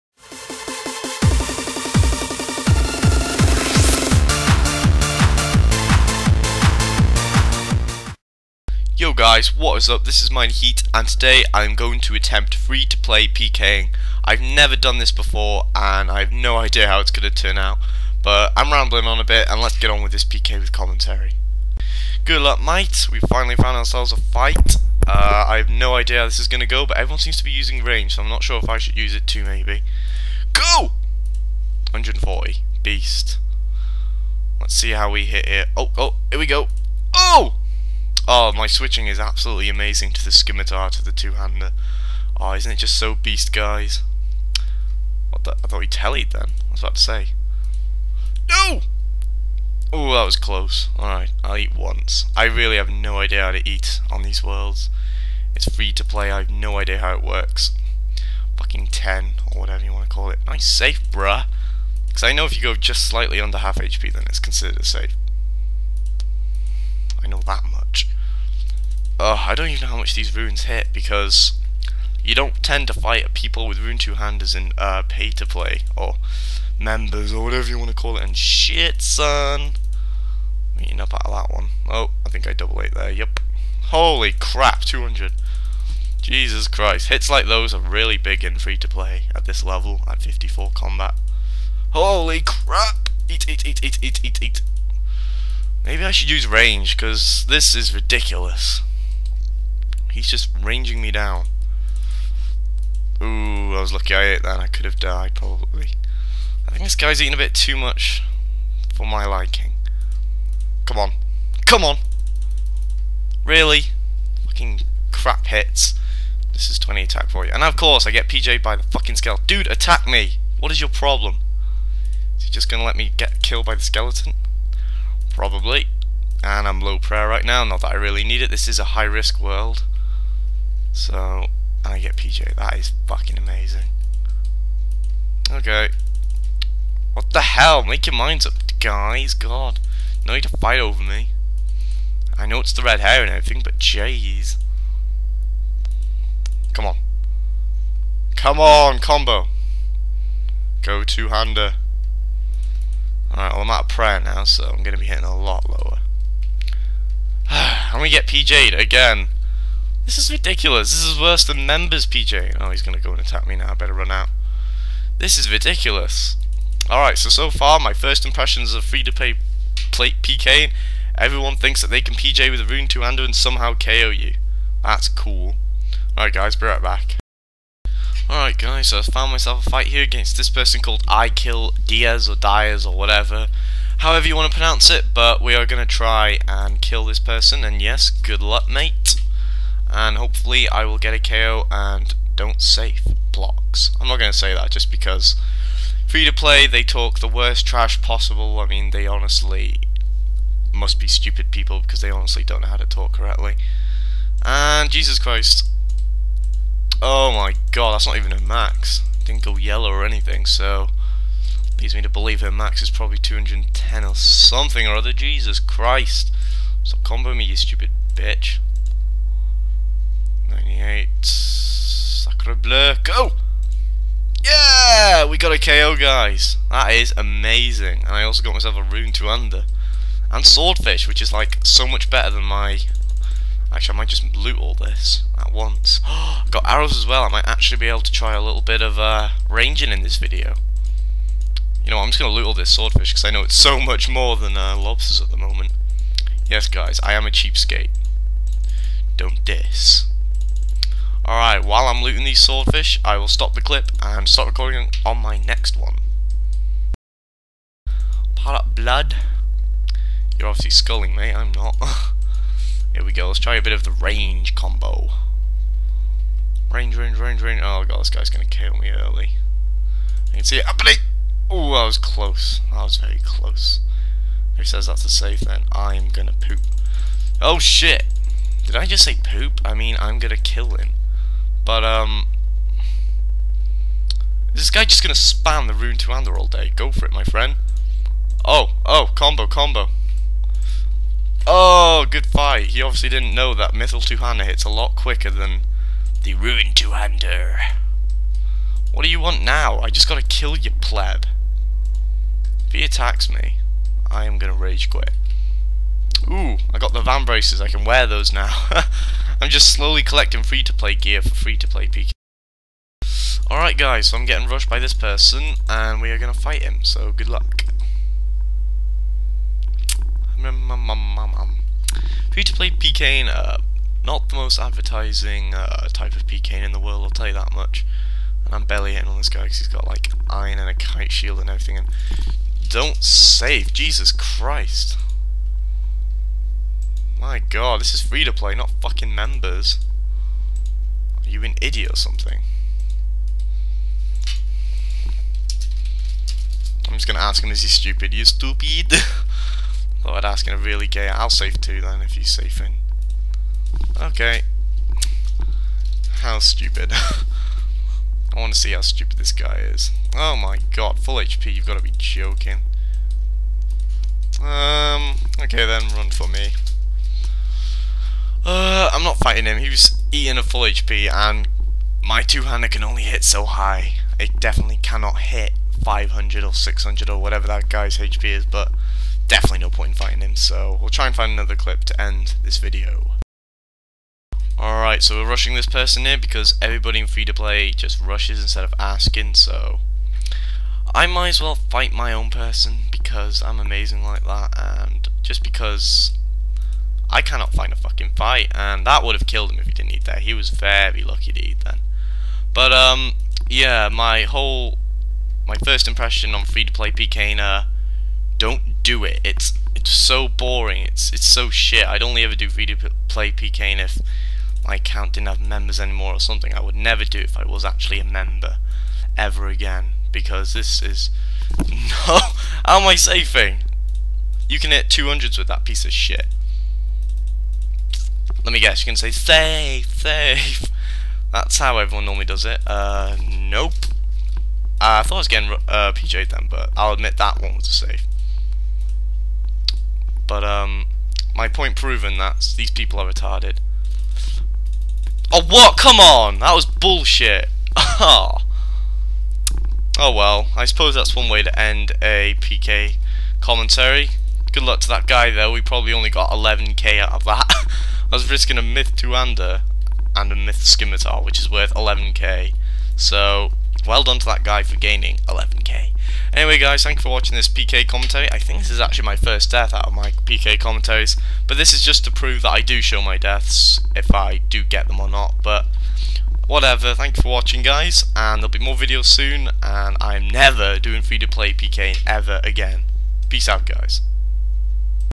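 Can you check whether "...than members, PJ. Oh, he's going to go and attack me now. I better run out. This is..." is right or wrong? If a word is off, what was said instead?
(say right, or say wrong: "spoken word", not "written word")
right.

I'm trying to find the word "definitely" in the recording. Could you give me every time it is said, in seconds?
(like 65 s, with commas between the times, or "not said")
374 s, 379 s.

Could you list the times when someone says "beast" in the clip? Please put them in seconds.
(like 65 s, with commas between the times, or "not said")
32 s, 43 s.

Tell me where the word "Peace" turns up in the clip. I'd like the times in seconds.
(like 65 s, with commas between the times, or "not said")
483 s.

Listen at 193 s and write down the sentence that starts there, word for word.
I'm not going to say that just because free to play they talk the worst trash possible.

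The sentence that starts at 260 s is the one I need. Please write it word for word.
You're obviously sculling me, I'm not.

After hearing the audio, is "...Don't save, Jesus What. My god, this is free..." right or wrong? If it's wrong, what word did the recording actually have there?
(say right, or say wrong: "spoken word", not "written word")
wrong: "Christ", not "What".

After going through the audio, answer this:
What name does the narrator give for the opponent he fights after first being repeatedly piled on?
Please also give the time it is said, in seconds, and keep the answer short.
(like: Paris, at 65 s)
I Kill Diaz, at 181 s.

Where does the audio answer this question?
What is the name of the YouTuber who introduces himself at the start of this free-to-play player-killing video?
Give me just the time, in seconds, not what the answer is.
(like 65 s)
10 s.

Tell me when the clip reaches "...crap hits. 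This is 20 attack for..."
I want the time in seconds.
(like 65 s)
115 s.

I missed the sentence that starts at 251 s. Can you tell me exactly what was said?
Alright, while I'm looting these swordfish, I will stop the clip and start recording on my next one.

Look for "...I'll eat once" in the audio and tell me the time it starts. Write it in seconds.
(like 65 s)
51 s.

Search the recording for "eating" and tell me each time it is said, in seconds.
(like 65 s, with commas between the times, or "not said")
107 s, 370 s.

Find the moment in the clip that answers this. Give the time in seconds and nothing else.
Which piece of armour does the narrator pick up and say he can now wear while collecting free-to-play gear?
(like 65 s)
307 s.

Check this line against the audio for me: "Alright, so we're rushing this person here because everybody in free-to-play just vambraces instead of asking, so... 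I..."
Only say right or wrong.
wrong.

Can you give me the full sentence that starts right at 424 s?
You can hit 200s with that piece of shit.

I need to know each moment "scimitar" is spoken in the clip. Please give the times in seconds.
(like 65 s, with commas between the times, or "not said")
40 s, 460 s.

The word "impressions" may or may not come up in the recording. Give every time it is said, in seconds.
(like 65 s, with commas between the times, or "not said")
168 s, 405 s.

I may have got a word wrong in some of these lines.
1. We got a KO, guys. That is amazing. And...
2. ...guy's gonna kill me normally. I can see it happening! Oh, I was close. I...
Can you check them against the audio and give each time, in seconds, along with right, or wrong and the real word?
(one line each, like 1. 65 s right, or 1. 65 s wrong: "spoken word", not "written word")
1. 225 s right
2. 268 s wrong: "early", not "normally".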